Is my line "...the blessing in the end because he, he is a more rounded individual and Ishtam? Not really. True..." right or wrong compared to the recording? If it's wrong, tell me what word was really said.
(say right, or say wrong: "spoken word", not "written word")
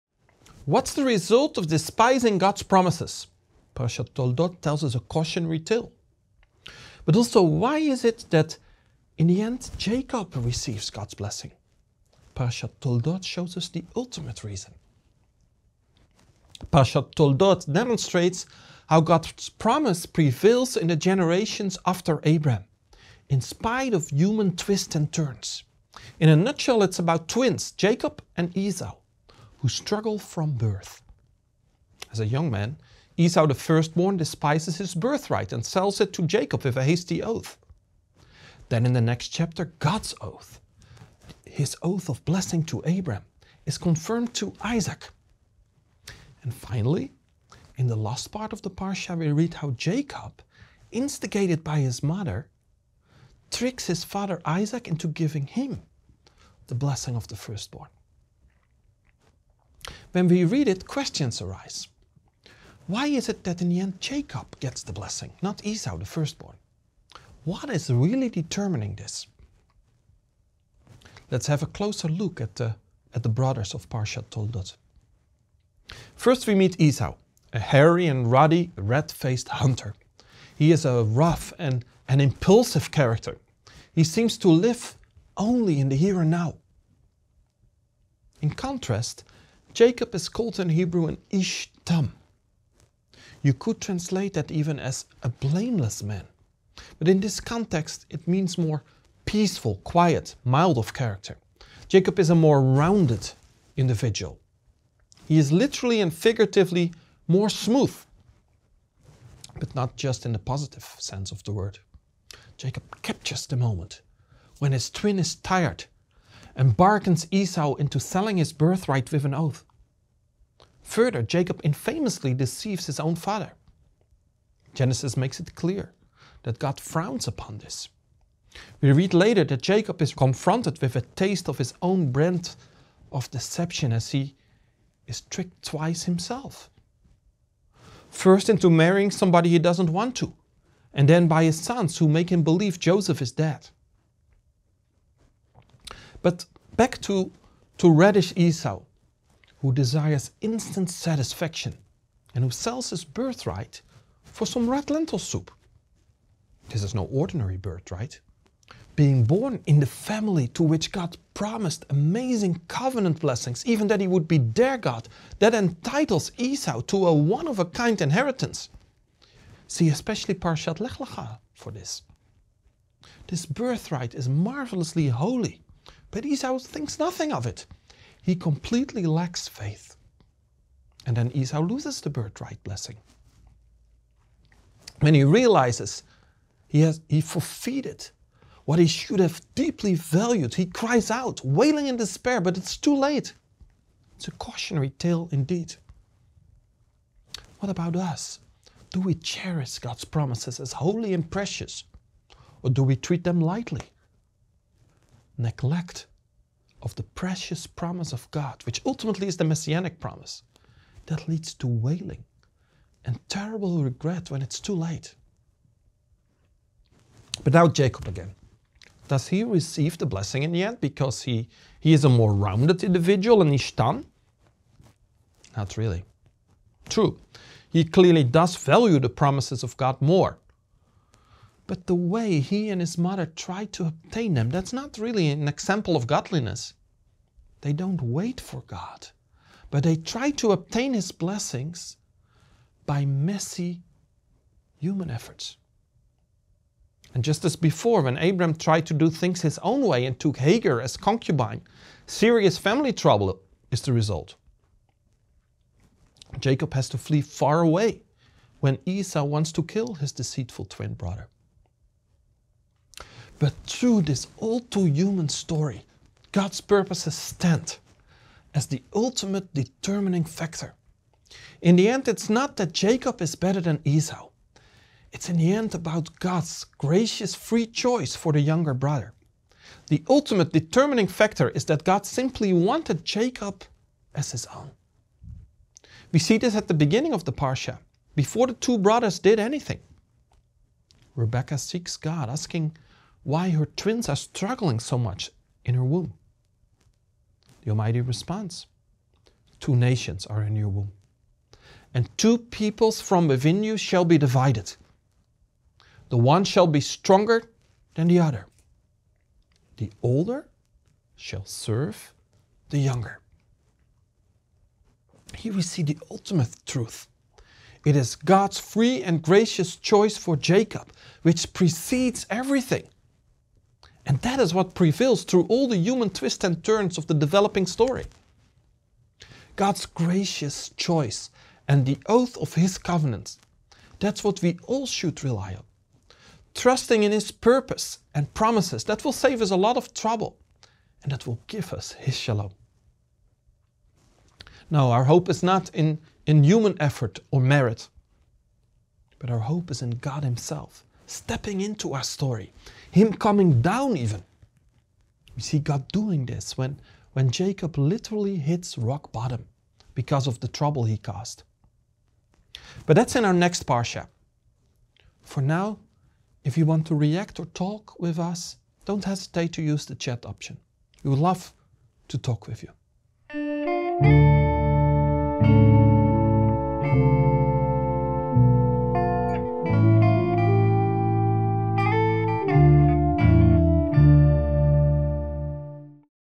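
right.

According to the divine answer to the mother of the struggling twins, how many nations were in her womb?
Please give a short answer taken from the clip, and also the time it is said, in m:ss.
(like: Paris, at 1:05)
2, at 4:59.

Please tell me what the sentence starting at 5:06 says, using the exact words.
The one shall be stronger than the other.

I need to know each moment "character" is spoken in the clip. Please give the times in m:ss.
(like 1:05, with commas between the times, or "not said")
1:22, 1:40.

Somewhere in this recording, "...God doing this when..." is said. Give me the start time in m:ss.
5:55.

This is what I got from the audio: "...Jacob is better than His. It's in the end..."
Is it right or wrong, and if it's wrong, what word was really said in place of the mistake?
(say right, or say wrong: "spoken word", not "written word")
wrong: "Esau", not "His".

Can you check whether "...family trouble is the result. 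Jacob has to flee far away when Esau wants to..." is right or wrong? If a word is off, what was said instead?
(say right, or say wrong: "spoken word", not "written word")
right.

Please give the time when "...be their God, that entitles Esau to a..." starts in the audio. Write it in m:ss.
2:44.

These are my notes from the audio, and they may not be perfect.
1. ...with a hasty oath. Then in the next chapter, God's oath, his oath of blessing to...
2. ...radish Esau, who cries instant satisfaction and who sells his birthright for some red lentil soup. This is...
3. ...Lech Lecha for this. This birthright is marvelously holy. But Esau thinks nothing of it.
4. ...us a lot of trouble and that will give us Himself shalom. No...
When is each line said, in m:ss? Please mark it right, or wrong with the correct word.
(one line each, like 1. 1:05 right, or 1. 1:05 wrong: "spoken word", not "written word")
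1. 0:36 right
2. 2:27 wrong: "desires", not "cries"
3. 2:50 right
4. 5:39 wrong: "His", not "Himself".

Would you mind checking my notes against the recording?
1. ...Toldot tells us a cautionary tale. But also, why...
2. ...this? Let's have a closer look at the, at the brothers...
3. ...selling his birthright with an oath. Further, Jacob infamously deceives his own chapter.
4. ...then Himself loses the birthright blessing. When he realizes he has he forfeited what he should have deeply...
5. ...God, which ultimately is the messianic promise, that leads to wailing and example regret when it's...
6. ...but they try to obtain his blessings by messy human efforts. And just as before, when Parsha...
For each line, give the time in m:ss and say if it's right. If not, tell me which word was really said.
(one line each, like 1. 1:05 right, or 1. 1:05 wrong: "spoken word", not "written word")
1. 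0:04 right
2. 1:08 right
3. 1:57 wrong: "father", not "chapter"
4. 3:01 wrong: "Esau", not "Himself"
5. 3:28 wrong: "terrible", not "example"
6. 3:59 wrong: "Abram", not "Parsha".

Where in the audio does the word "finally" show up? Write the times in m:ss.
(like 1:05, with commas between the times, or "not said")
0:46.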